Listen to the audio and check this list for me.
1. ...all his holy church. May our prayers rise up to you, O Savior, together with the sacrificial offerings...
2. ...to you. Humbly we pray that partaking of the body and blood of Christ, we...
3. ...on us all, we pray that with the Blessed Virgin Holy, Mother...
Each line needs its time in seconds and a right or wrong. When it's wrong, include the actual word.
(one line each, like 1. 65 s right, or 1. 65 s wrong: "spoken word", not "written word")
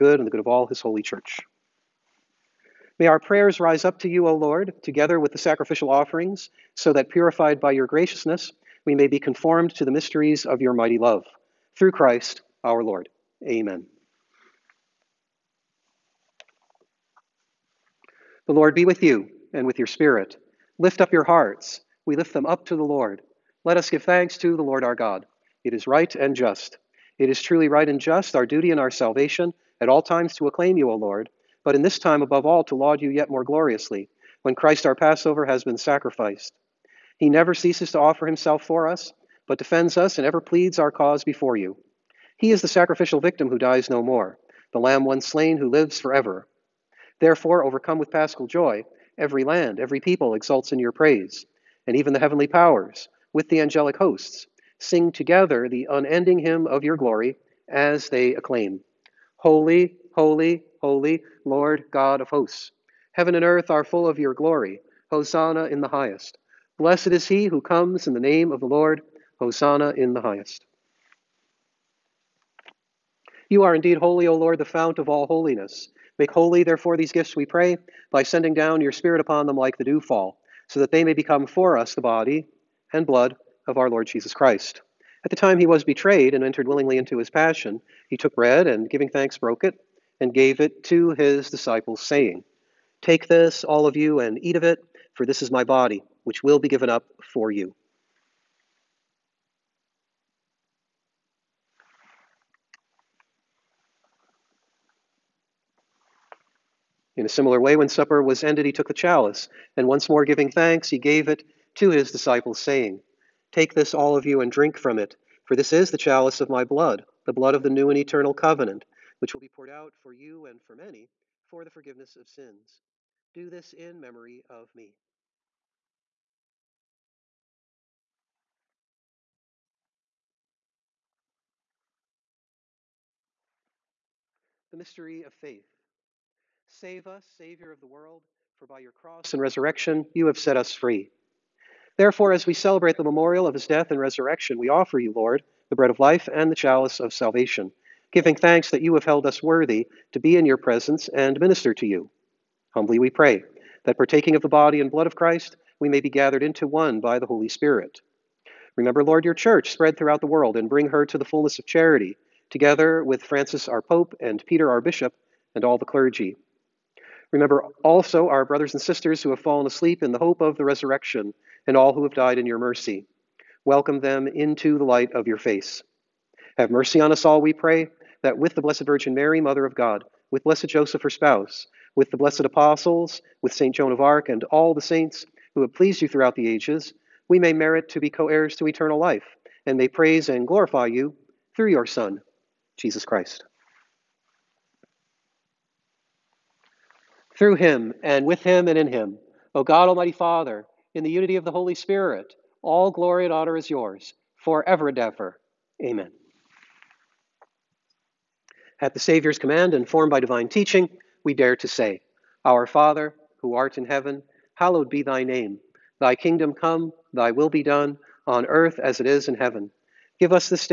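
1. 0 s wrong: "Lord", not "Savior"
2. 151 s right
3. 176 s wrong: "Mary", not "Holy".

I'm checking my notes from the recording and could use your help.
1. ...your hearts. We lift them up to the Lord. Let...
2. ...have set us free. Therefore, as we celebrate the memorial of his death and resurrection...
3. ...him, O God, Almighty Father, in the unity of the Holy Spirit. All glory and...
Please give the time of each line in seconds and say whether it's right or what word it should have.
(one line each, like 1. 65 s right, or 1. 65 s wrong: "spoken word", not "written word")
1. 21 s right
2. 140 s right
3. 198 s right.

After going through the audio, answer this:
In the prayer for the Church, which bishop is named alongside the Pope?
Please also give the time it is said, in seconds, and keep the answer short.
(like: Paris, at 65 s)
Peter, at 164 s.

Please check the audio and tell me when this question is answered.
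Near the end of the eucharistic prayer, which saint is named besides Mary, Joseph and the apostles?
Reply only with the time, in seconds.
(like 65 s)
183 s.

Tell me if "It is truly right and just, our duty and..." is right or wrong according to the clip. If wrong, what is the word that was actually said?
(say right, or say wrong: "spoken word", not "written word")
right.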